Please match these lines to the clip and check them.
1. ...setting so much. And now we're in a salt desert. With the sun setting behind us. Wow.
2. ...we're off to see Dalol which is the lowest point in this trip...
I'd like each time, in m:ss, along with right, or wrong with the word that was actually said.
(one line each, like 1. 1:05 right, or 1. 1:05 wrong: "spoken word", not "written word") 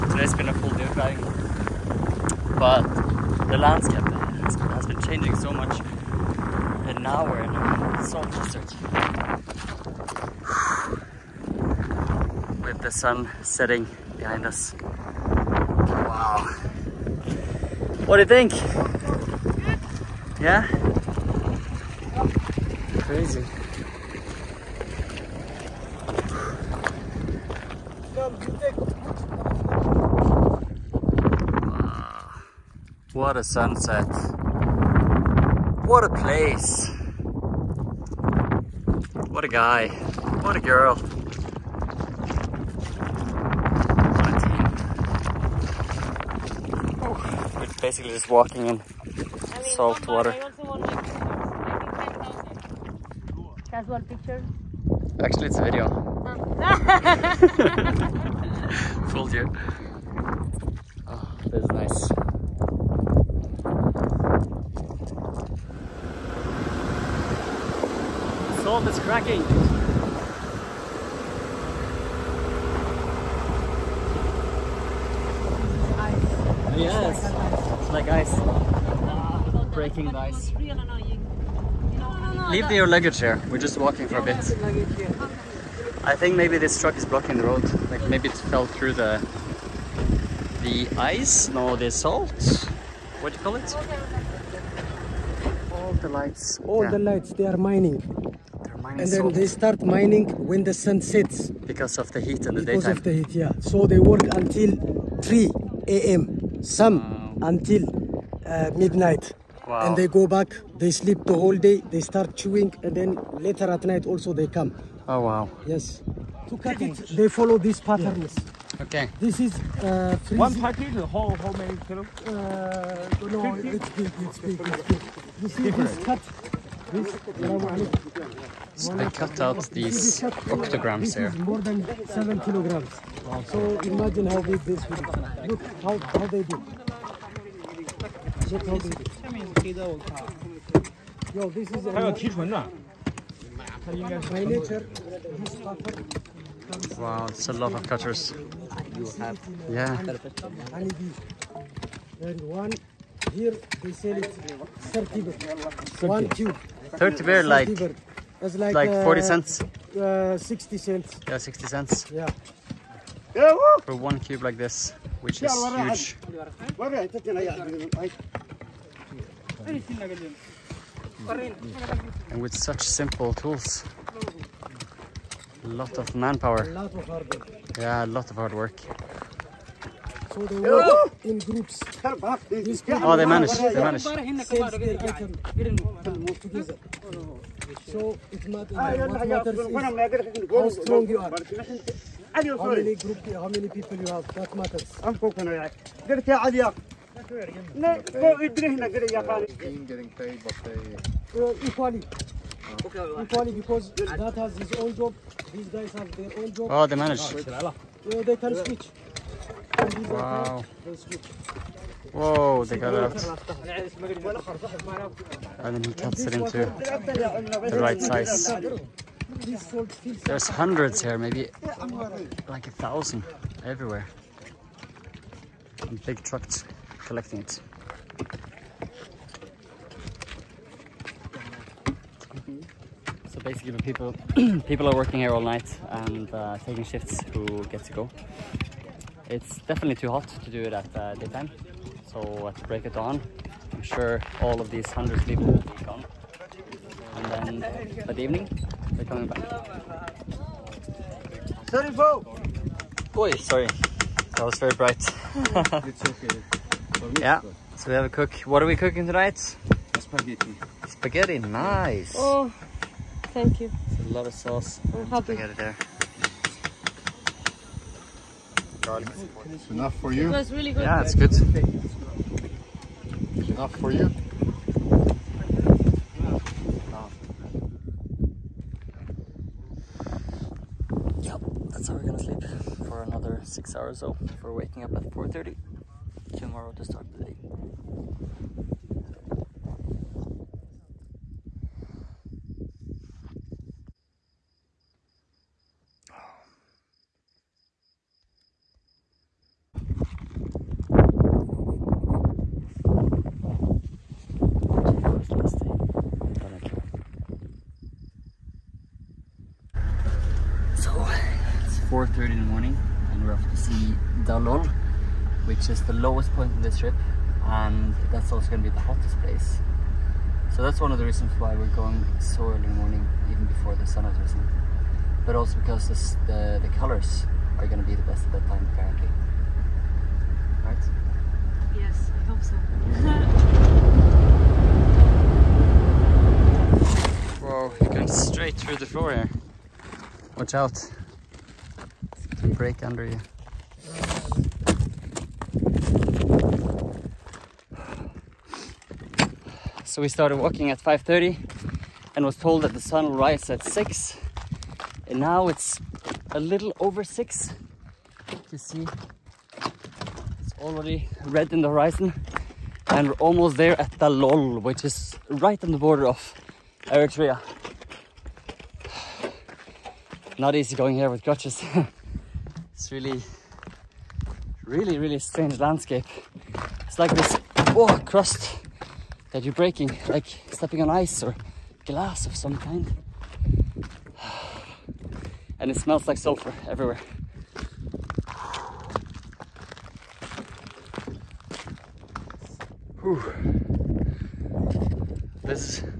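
1. 0:05 wrong: "changing", not "setting"
2. 5:13 right.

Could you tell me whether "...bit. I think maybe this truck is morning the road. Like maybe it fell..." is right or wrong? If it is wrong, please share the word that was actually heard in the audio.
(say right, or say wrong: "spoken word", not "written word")
wrong: "blocking", not "morning".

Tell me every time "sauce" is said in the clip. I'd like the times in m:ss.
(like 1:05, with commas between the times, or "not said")
4:24.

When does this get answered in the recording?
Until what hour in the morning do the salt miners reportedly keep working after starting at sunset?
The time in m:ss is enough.
1:45.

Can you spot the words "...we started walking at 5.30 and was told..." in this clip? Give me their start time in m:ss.
5:50.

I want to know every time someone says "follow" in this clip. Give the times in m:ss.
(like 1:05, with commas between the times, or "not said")
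1:57.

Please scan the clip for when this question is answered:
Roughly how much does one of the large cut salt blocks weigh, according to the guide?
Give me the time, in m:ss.
2:11.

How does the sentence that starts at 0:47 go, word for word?
Oh, basically just walking in salt water.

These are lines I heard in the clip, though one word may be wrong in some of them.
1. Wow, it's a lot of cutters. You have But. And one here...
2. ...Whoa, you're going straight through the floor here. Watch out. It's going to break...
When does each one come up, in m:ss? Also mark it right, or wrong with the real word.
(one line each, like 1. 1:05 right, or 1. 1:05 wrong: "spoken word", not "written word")
1. 2:26 wrong: "Yeah", not "But"
2. 5:37 right.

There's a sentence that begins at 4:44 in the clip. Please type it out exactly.
we're waking up at 4.30 tomorrow the day.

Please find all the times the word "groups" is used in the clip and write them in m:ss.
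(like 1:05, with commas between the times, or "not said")
3:01, 3:12.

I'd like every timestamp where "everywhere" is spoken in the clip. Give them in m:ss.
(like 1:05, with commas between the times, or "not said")
3:43, 6:26.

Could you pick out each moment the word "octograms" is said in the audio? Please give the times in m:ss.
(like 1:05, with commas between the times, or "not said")
2:10.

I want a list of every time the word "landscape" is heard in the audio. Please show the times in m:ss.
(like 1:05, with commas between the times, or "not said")
0:03, 6:15.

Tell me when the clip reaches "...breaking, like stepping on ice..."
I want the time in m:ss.
6:19.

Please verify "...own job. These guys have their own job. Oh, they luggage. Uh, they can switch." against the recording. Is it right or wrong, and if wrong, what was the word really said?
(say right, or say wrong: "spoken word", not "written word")
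wrong: "manage", not "luggage".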